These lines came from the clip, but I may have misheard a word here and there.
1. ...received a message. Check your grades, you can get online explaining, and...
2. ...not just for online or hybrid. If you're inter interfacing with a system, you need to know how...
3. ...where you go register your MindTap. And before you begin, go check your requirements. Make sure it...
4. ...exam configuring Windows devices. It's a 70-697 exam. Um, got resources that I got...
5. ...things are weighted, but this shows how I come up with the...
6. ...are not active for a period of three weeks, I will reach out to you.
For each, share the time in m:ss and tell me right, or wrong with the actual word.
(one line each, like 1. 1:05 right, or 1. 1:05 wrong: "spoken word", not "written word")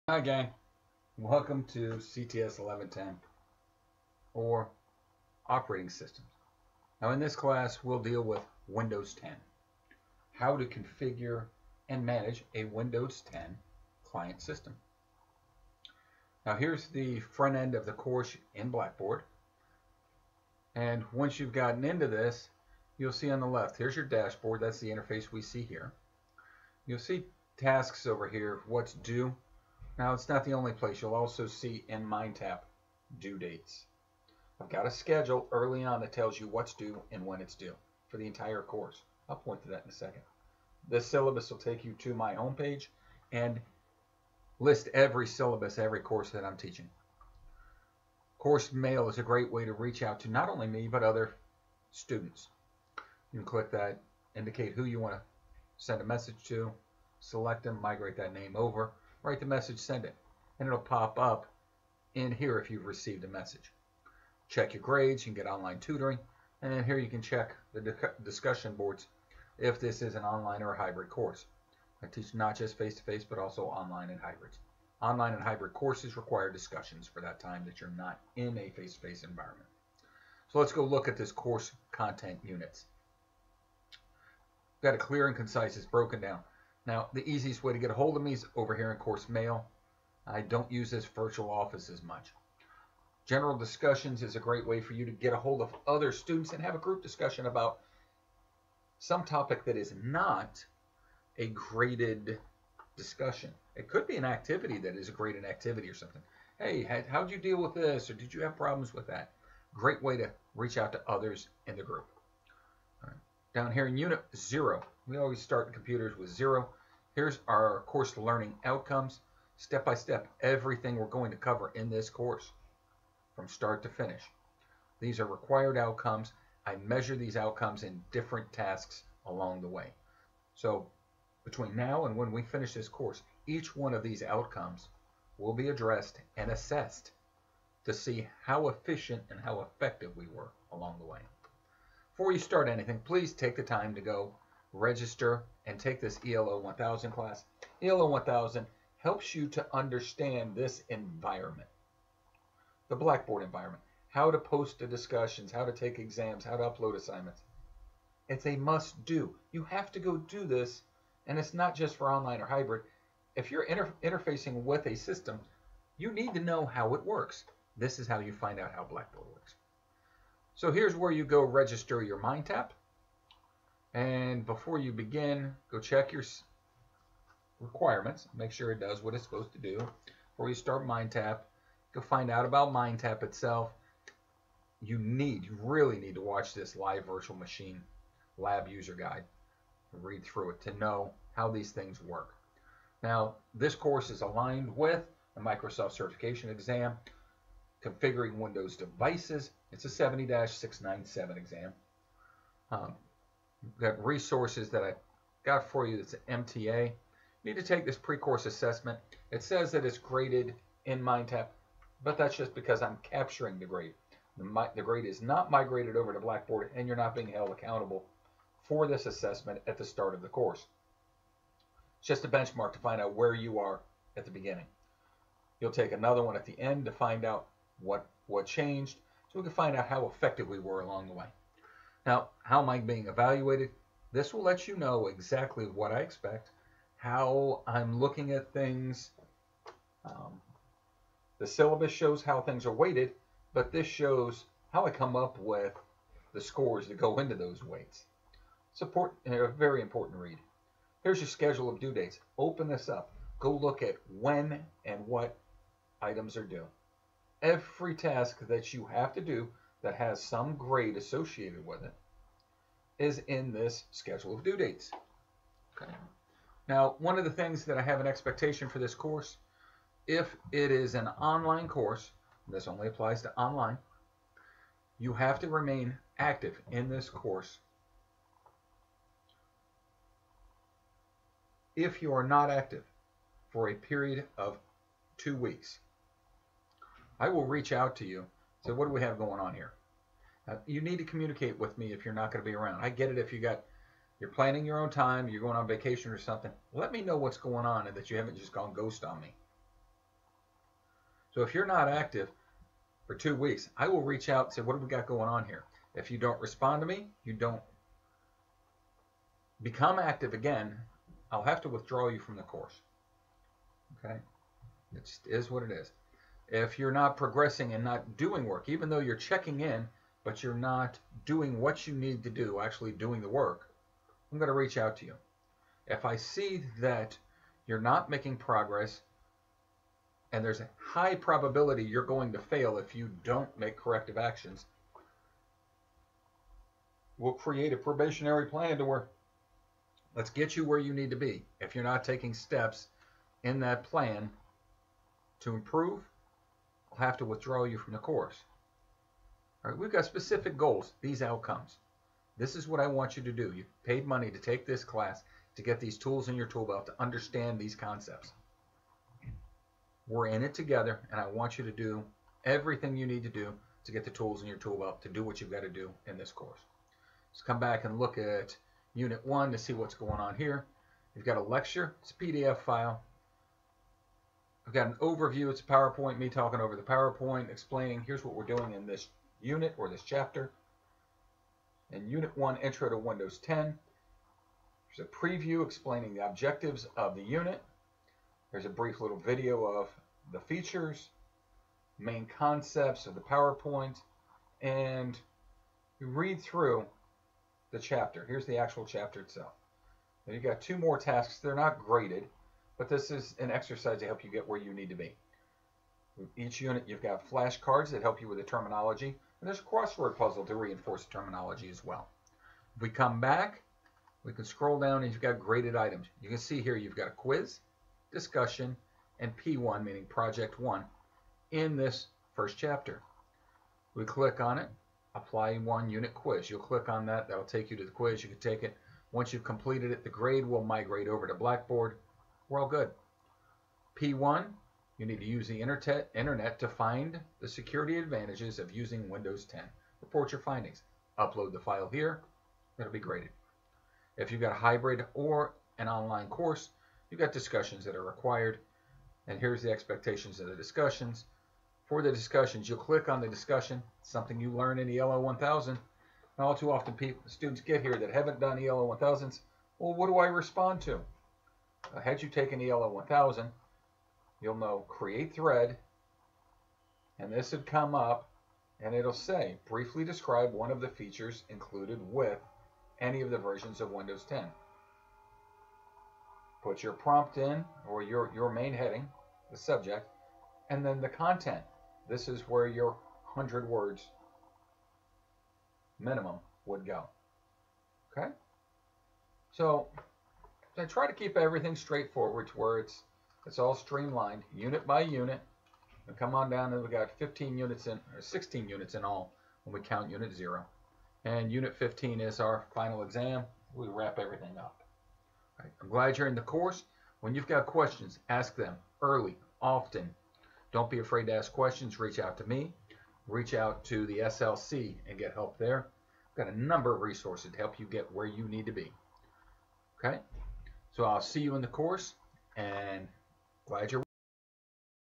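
1. 1:02 wrong: "tutoring", not "explaining"
2. 2:41 right
3. 2:50 right
4. 3:16 right
5. 4:02 right
6. 4:42 wrong: "two", not "three".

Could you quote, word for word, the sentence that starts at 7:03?
We click on it, apply one unit quiz.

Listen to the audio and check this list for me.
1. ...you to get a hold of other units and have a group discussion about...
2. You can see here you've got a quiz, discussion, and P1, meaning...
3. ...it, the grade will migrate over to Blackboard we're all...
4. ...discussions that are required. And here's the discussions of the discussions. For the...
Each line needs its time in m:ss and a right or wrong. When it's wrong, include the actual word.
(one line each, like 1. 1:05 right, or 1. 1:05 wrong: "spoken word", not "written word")
1. 1:34 wrong: "students", not "units"
2. 6:56 right
3. 7:09 right
4. 7:27 wrong: "expectations", not "discussions".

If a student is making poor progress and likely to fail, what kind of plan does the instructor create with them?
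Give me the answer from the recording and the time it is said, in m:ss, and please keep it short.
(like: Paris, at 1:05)
probationary plan, at 5:37.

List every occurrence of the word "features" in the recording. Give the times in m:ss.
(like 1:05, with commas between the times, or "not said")
6:30, 7:50.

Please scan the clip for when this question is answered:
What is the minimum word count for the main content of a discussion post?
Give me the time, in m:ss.
8:03.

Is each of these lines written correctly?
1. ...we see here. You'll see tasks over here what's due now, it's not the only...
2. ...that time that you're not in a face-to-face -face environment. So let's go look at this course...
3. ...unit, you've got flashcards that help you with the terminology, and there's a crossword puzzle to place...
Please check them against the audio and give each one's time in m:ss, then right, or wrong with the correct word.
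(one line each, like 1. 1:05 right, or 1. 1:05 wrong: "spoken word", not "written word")
1. 0:25 right
2. 1:17 right
3. 6:46 wrong: "reinforce", not "place".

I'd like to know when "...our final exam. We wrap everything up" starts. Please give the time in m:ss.
8:22.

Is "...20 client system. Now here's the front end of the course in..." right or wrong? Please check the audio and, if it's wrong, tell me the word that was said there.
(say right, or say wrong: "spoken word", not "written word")
wrong: "10", not "20".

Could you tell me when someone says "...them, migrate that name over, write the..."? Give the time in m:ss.
0:57.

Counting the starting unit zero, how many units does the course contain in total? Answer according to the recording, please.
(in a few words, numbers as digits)
16.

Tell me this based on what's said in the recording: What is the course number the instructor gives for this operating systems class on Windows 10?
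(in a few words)
CTS 1110.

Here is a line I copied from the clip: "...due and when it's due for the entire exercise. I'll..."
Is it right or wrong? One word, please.
wrong.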